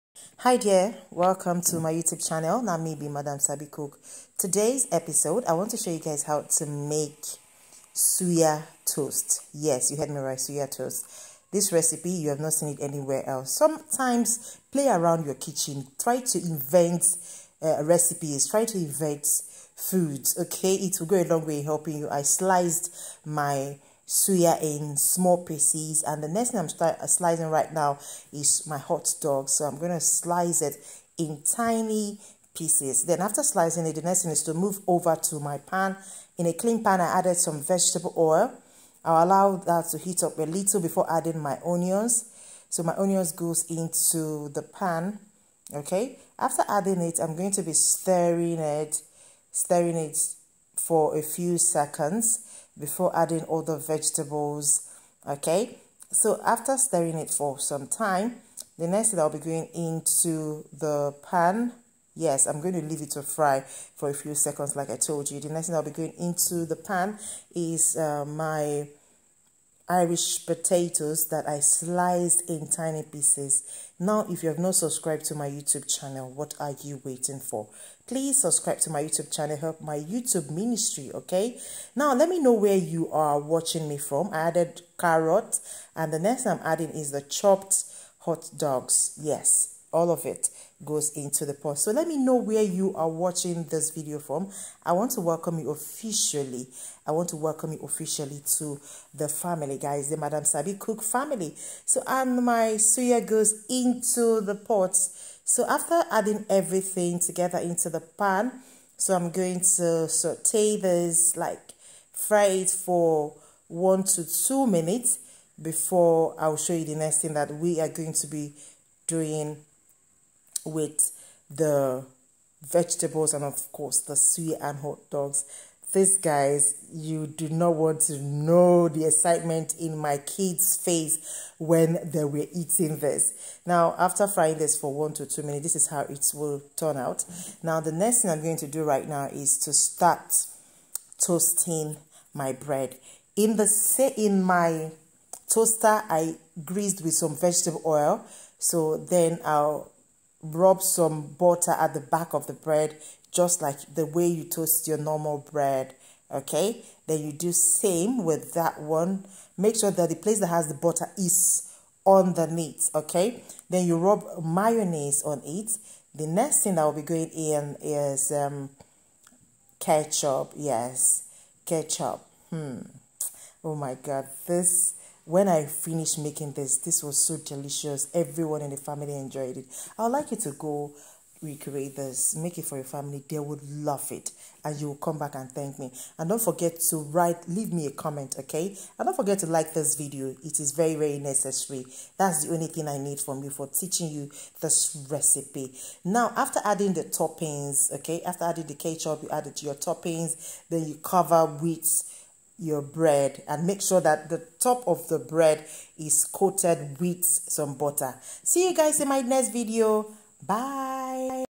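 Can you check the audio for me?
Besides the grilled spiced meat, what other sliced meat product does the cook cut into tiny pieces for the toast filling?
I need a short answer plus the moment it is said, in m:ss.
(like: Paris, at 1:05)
hot dog, at 0:28.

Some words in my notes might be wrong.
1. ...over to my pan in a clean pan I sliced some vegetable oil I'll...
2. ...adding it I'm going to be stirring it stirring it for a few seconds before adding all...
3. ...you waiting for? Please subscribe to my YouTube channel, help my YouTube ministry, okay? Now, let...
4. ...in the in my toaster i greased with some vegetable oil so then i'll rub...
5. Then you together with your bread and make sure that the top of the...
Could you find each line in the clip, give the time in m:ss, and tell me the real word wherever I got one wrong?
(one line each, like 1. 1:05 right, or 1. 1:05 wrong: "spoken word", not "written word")
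1. 0:34 wrong: "added", not "sliced"
2. 0:46 right
3. 1:16 right
4. 2:23 right
5. 3:20 wrong: "cover", not "together".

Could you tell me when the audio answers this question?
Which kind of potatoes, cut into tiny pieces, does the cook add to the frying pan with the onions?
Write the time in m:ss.
1:09.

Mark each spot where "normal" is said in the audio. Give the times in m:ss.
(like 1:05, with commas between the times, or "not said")
2:34.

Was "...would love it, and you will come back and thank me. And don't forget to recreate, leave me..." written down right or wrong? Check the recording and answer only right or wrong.
wrong.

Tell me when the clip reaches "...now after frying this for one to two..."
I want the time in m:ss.
2:13.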